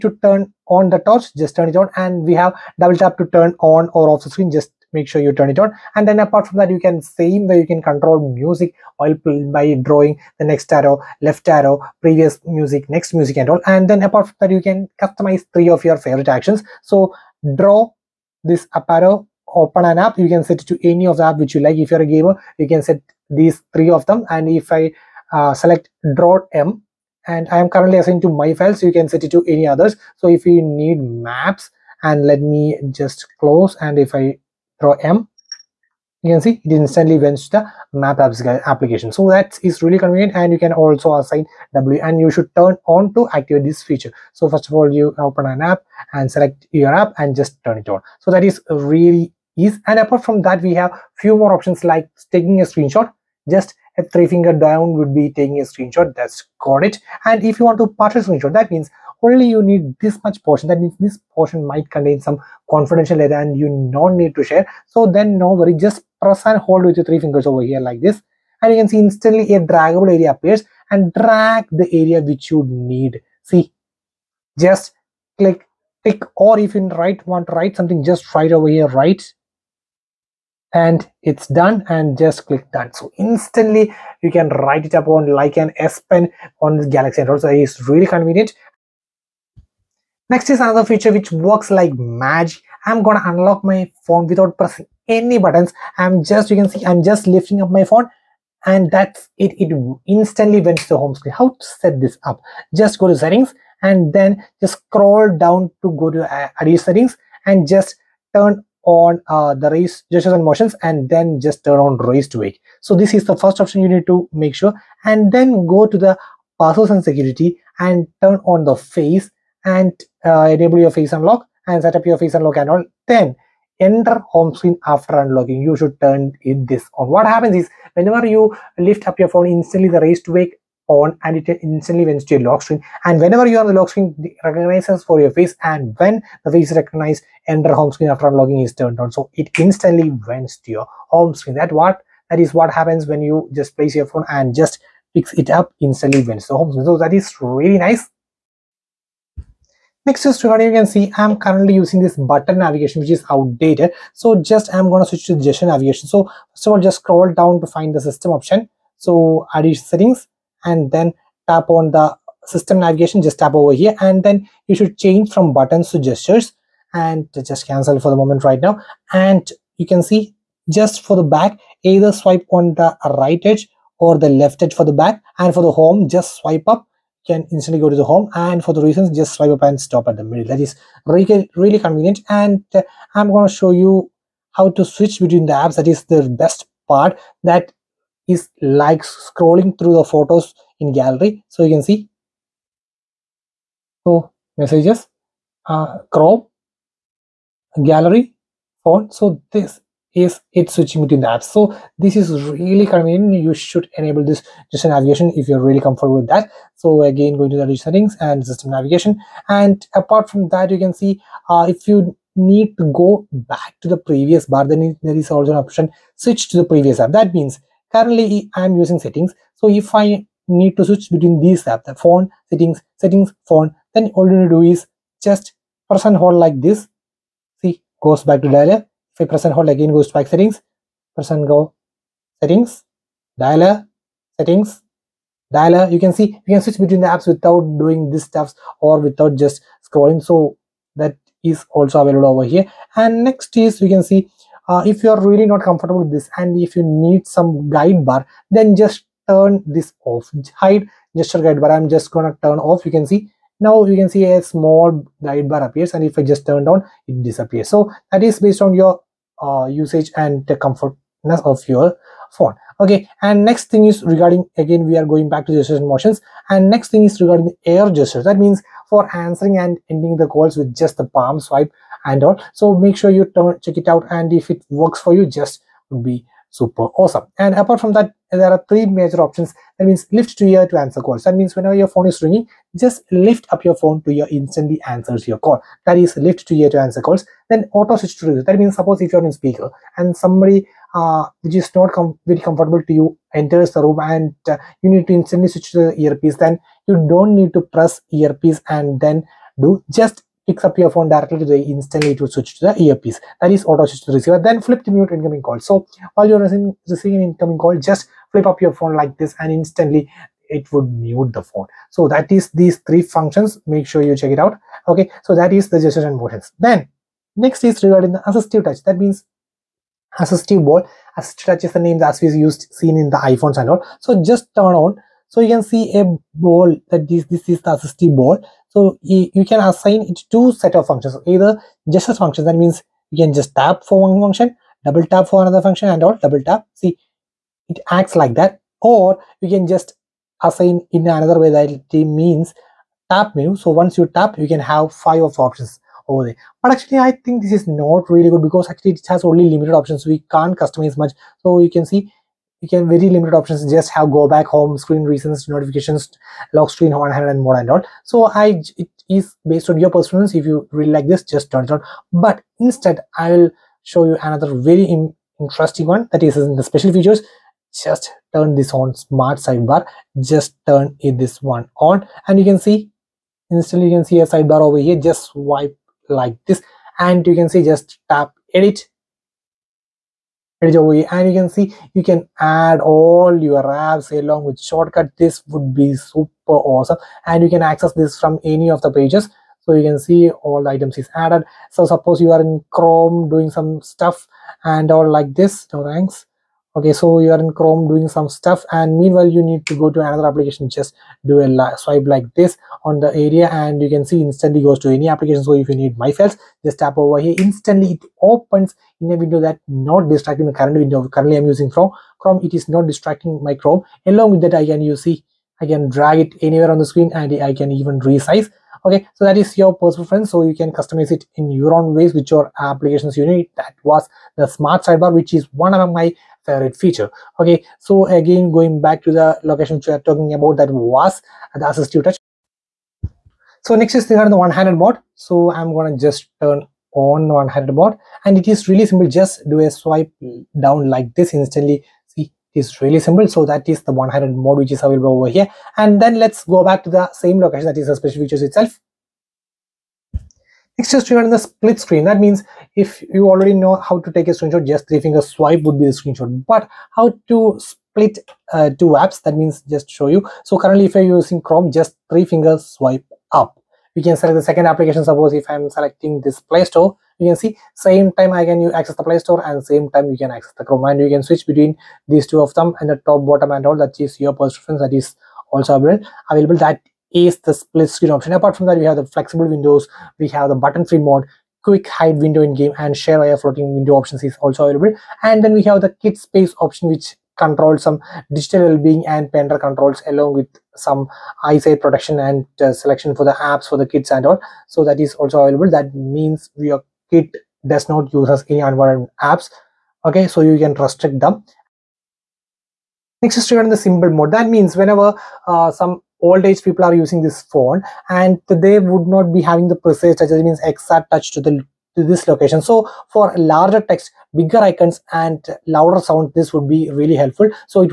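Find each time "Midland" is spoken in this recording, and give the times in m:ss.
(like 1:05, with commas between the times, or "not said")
not said.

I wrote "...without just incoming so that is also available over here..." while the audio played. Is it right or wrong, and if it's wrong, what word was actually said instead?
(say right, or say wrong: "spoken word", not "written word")
wrong: "scrolling", not "incoming".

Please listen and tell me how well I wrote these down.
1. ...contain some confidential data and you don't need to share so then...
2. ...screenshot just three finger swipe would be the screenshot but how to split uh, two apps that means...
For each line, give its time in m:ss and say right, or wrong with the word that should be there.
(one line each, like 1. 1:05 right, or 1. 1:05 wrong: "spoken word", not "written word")
1. 1:01 right
2. 7:34 right.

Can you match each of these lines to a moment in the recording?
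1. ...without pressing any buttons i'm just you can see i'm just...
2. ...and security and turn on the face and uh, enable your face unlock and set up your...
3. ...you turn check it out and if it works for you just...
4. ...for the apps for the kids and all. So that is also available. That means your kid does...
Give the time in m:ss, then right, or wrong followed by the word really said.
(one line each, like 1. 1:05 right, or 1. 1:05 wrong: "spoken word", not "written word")
1. 1:34 right
2. 1:56 right
3. 4:33 right
4. 8:13 right.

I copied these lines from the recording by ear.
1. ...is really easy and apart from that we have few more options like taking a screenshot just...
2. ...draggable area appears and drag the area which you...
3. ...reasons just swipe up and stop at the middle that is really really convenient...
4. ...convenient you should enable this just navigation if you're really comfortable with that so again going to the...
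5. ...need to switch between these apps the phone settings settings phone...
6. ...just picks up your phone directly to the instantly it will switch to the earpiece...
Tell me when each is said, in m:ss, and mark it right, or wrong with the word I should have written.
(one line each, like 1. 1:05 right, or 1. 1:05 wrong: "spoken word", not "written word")
1. 0:48 right
2. 1:09 right
3. 2:58 right
4. 3:22 right
5. 3:40 right
6. 4:59 right.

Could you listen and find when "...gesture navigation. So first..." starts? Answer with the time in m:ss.
2:35.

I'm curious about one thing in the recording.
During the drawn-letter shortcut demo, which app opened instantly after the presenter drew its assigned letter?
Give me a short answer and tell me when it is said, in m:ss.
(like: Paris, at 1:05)
Maps, at 0:31.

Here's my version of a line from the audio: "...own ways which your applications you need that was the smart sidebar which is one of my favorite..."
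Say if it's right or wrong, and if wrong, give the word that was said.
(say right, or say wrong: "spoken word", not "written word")
right.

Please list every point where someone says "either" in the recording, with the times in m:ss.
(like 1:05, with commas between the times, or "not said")
2:51, 5:31.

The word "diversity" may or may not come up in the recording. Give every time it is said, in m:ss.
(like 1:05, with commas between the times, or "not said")
not said.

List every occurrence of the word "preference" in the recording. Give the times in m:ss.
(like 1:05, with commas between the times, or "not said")
5:59, 7:00, 7:54.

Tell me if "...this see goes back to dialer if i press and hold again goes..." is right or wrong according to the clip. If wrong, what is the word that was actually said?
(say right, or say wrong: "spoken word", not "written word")
right.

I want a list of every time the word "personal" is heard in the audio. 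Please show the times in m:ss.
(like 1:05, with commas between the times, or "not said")
6:59, 7:54.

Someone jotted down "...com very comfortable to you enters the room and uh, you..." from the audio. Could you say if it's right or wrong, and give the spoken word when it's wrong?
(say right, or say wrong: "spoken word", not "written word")
right.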